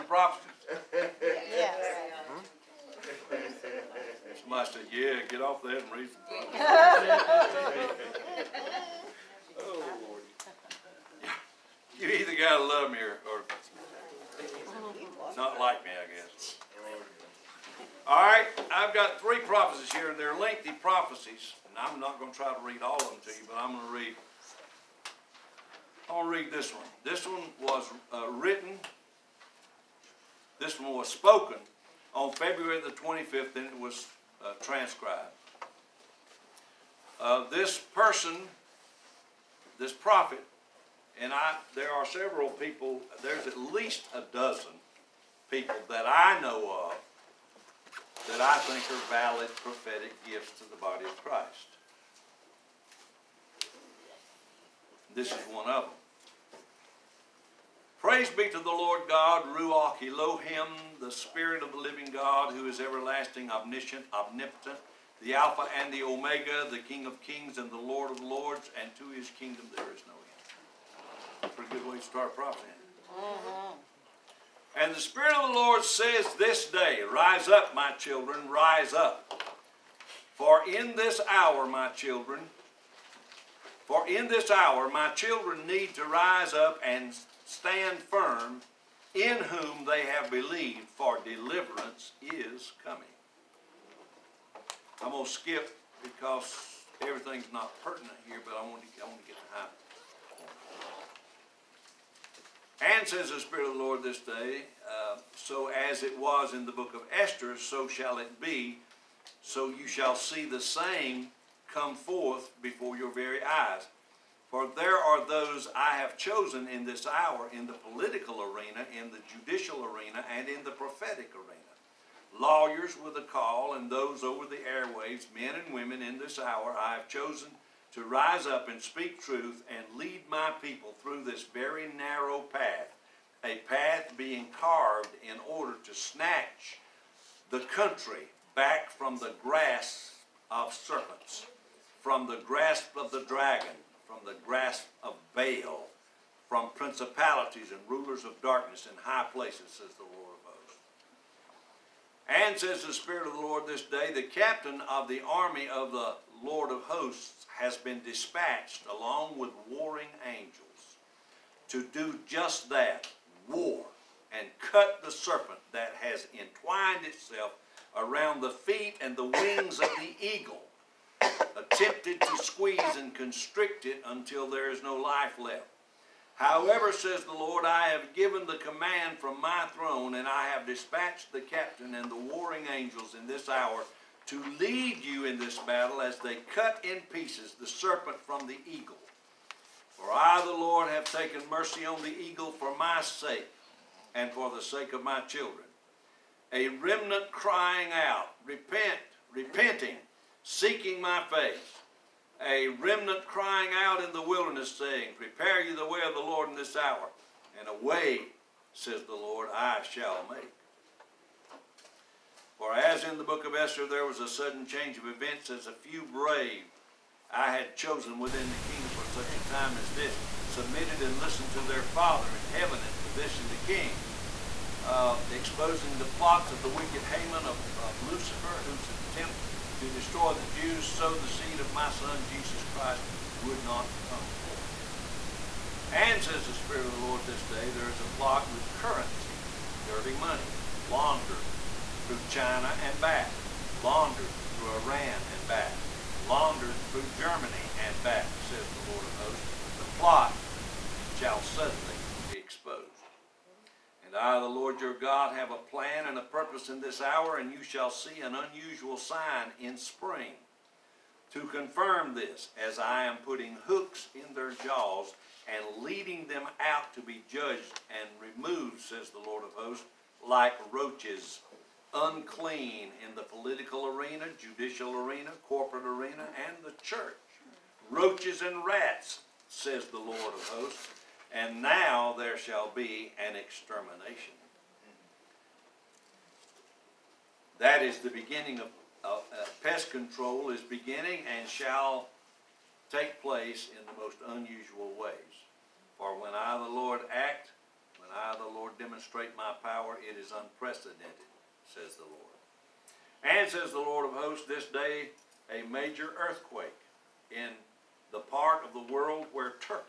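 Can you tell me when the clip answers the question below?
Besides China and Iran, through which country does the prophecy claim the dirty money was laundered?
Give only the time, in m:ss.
4:07.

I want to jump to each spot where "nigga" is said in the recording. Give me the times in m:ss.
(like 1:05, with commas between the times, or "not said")
not said.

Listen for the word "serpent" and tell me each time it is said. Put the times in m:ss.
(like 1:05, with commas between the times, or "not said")
2:20, 2:45, 3:07.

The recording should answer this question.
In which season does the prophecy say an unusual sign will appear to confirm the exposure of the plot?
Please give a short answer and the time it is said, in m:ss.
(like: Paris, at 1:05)
spring, at 4:19.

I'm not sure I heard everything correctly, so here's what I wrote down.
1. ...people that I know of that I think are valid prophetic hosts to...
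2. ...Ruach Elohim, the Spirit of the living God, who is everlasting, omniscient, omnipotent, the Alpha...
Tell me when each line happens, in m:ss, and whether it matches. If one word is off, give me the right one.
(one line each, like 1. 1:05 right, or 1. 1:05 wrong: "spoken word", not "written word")
1. 0:45 wrong: "gifts", not "hosts"
2. 0:59 right.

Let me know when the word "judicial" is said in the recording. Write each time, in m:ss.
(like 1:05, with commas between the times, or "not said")
1:59, 4:34.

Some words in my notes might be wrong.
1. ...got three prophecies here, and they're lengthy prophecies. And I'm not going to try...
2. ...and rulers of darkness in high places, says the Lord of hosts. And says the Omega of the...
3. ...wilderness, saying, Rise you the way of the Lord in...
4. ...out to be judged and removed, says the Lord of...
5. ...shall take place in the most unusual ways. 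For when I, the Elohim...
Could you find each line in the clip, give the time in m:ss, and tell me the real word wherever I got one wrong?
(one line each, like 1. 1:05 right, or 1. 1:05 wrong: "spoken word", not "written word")
1. 0:18 right
2. 2:27 wrong: "Spirit", not "Omega"
3. 3:24 wrong: "Prepare", not "Rise"
4. 4:26 right
5. 4:51 wrong: "Lord", not "Elohim".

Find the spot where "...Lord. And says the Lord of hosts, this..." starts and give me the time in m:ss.
5:02.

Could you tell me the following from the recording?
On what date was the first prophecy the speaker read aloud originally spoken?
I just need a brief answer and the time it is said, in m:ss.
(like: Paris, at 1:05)
February 25, at 0:32.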